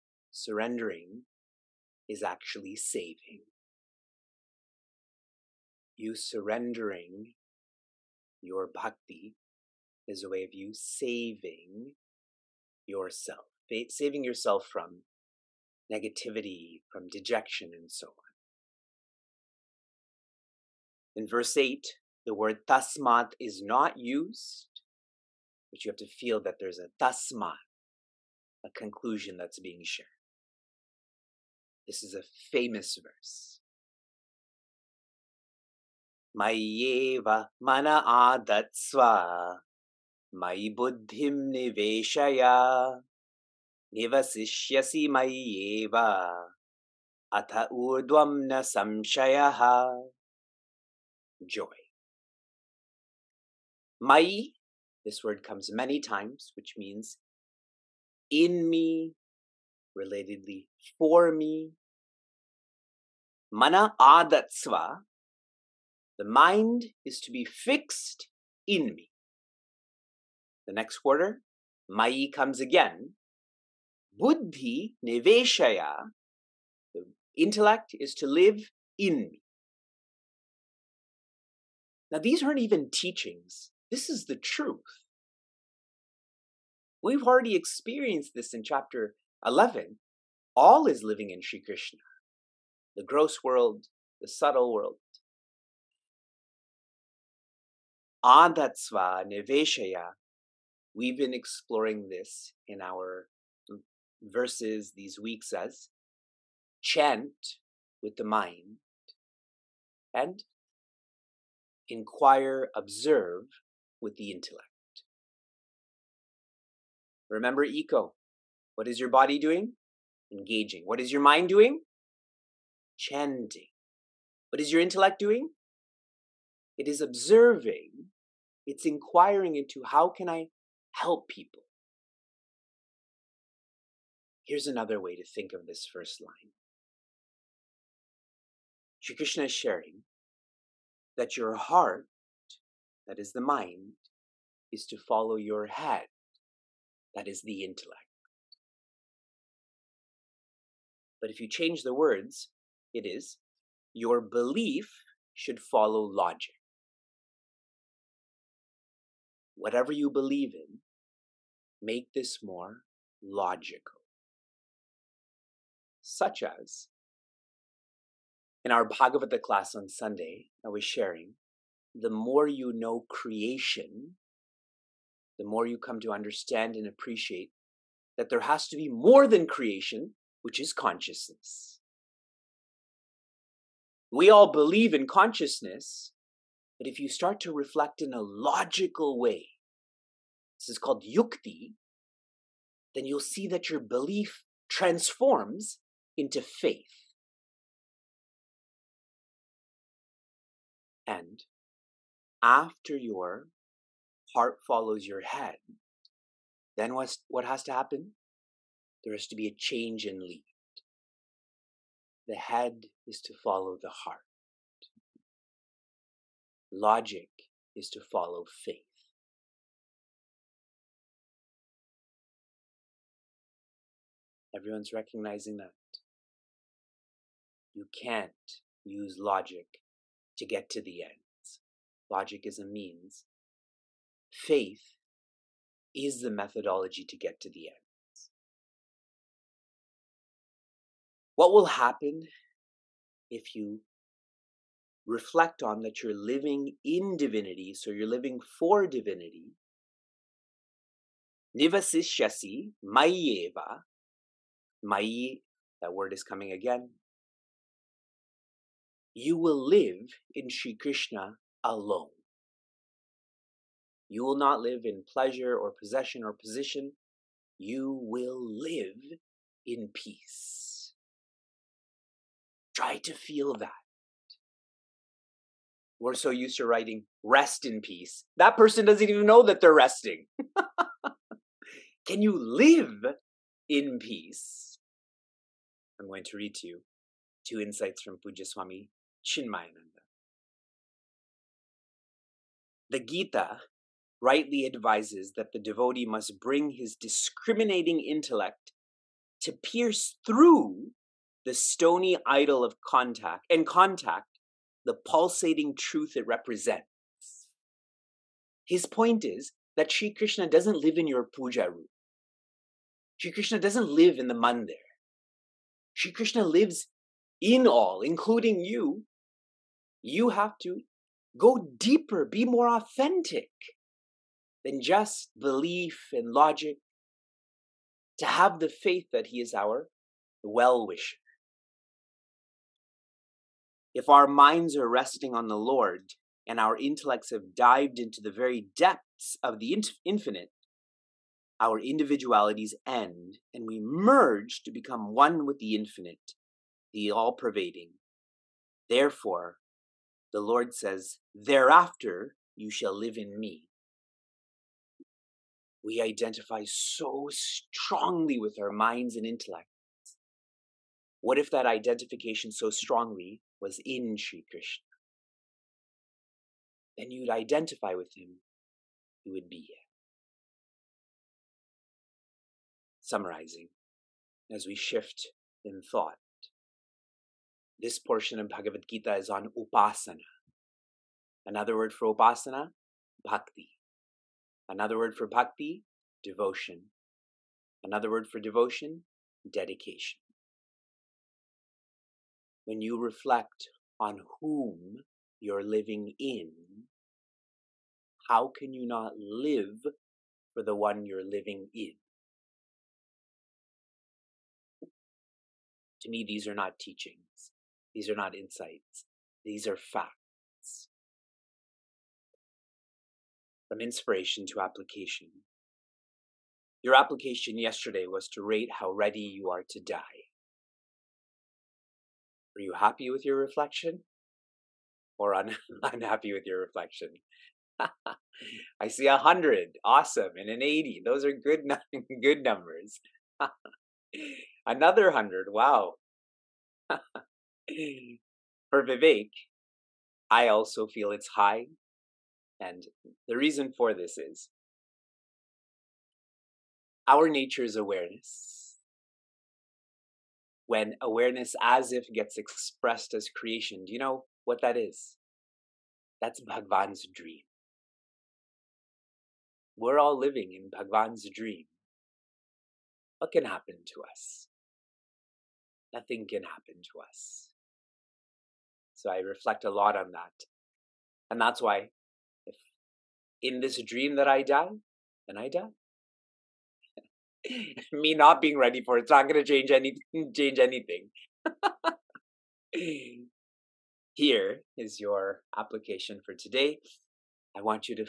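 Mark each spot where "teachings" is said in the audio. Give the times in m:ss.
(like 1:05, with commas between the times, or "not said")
1:22, 6:46.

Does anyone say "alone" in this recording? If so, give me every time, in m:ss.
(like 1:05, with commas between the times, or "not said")
4:21.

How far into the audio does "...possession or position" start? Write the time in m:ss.
4:25.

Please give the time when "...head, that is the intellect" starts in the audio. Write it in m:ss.
2:25.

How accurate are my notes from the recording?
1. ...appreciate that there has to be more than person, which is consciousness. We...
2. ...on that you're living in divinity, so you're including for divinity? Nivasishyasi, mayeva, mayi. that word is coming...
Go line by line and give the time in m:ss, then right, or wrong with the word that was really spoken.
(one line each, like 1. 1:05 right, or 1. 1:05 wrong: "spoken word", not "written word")
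1. 2:56 wrong: "creation", not "person"
2. 4:05 wrong: "living", not "including".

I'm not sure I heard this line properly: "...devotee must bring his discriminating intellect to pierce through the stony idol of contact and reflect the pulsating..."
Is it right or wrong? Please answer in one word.
wrong.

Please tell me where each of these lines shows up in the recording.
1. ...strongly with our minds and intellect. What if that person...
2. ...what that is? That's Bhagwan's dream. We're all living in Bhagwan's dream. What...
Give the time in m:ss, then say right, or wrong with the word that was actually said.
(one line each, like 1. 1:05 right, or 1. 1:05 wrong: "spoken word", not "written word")
1. 5:57 wrong: "identification", not "person"
2. 7:34 right.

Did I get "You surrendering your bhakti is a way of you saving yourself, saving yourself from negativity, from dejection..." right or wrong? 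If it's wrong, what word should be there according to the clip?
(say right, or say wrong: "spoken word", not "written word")
right.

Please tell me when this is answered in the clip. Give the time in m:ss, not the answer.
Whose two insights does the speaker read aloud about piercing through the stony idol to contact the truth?
4:48.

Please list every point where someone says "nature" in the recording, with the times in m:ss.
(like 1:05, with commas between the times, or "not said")
7:27.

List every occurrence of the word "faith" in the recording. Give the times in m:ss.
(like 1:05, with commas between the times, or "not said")
3:16, 3:38, 3:54, 5:28.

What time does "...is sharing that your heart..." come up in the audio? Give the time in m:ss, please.
2:19.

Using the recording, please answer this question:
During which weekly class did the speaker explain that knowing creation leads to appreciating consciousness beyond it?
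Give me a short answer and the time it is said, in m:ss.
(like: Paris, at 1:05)
Bhagavata class on Sunday, at 2:48.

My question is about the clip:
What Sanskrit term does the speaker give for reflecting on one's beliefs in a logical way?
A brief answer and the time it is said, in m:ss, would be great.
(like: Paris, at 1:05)
yukti, at 3:11.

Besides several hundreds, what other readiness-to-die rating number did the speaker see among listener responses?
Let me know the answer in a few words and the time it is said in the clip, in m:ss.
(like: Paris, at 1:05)
80, at 7:10.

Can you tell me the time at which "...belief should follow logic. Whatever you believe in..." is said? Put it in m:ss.
2:34.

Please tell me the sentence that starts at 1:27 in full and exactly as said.
We've already experienced this in chapter 11.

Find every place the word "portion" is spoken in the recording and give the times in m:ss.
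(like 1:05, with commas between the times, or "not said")
6:17.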